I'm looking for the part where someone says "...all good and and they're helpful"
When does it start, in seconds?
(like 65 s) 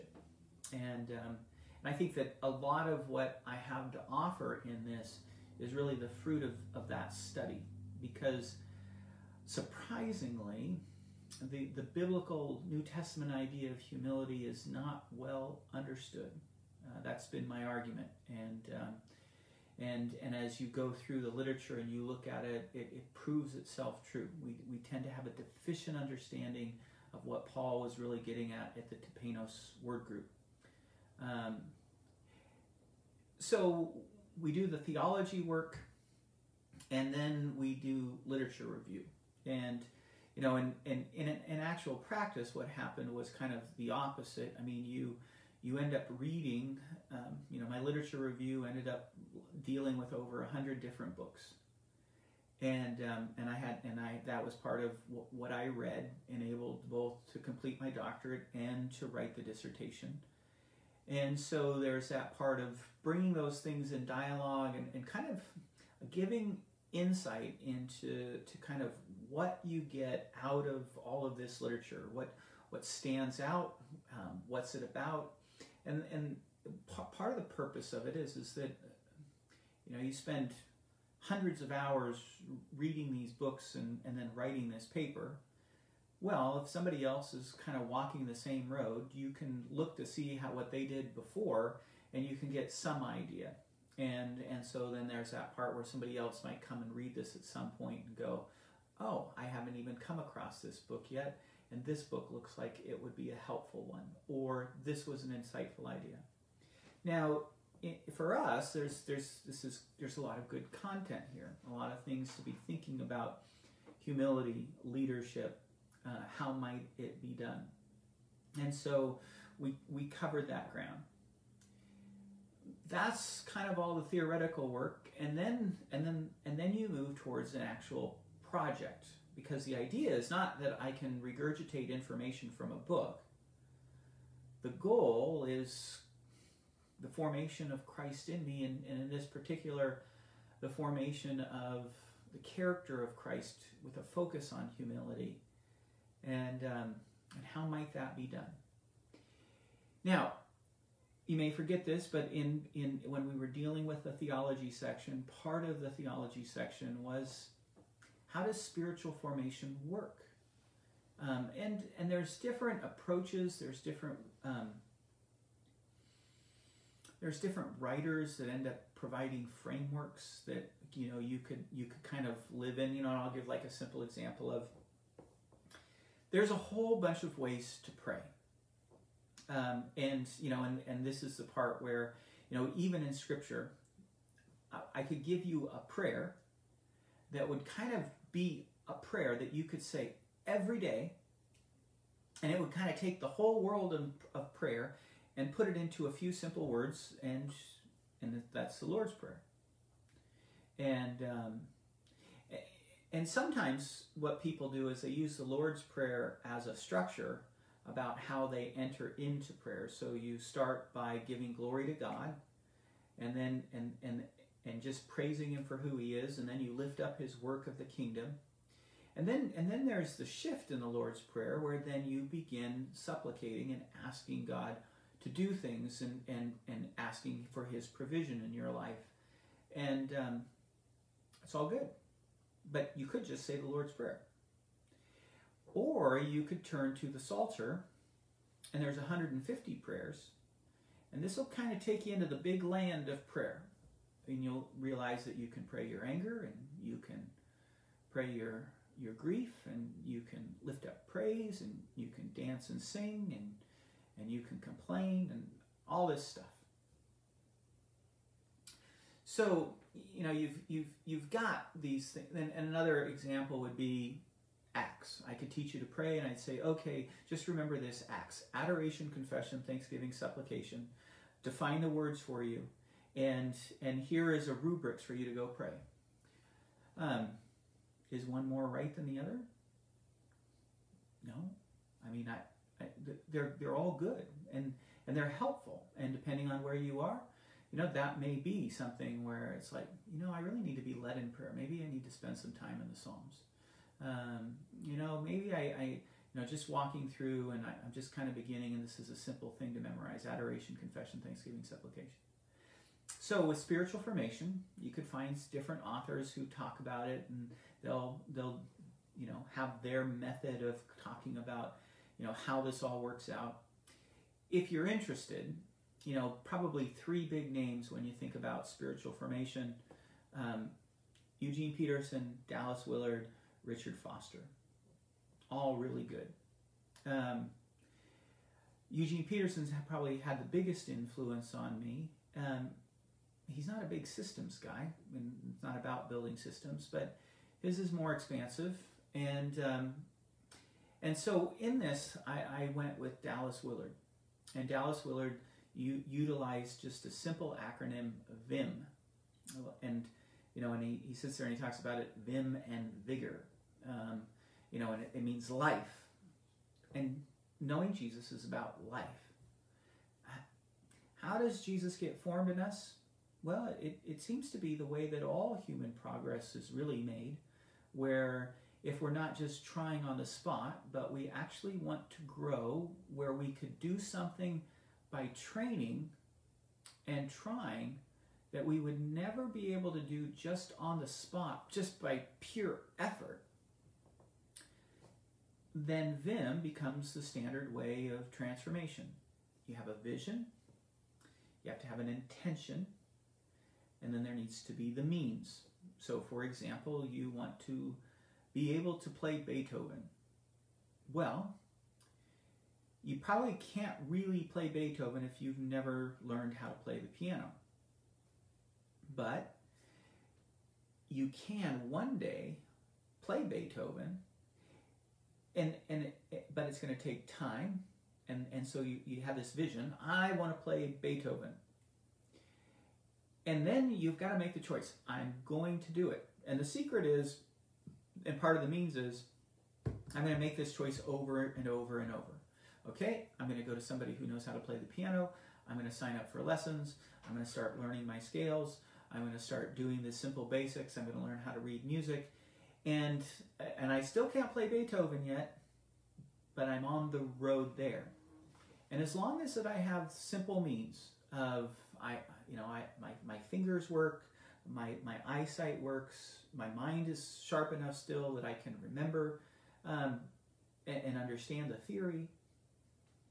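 283 s.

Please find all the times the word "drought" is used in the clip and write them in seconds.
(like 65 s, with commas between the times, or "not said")
not said.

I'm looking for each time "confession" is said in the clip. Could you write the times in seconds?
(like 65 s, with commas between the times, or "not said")
269 s, 300 s.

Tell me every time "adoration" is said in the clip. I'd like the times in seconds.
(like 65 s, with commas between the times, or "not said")
268 s, 300 s.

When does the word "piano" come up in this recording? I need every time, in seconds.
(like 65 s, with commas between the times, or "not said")
407 s, 434 s.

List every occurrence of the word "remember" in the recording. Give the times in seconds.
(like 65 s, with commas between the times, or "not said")
267 s, 458 s.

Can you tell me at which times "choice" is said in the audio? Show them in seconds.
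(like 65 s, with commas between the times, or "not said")
424 s, 430 s.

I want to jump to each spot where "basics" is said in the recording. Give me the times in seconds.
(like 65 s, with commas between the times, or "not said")
440 s.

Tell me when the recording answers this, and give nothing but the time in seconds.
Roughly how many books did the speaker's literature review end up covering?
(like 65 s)
50 s.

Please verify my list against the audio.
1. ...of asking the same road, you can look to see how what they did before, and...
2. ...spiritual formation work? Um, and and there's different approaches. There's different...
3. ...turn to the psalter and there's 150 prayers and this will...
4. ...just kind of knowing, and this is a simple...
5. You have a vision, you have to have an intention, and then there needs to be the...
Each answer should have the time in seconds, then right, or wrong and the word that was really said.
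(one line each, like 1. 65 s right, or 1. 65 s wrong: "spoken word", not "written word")
1. 87 s wrong: "walking", not "asking"
2. 158 s right
3. 236 s right
4. 297 s wrong: "beginning", not "knowing"
5. 389 s right.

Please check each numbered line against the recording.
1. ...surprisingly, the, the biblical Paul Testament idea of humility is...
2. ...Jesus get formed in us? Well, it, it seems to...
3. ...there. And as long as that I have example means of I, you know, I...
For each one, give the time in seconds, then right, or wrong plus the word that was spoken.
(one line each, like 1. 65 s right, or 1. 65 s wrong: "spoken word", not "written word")
1. 9 s wrong: "New", not "Paul"
2. 361 s right
3. 447 s wrong: "simple", not "example".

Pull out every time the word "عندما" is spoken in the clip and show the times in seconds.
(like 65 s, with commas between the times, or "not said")
not said.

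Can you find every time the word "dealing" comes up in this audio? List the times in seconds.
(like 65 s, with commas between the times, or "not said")
49 s, 153 s.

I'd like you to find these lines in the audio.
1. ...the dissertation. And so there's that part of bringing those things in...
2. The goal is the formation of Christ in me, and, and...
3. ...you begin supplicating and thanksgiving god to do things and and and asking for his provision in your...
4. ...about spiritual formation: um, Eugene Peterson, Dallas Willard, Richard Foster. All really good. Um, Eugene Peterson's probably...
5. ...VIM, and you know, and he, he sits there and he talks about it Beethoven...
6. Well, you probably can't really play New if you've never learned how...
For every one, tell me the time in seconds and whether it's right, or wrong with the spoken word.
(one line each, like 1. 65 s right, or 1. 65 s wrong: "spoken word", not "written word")
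1. 59 s right
2. 134 s right
3. 222 s wrong: "asking", not "thanksgiving"
4. 318 s right
5. 348 s wrong: "VIM", not "Beethoven"
6. 401 s wrong: "Beethoven", not "New".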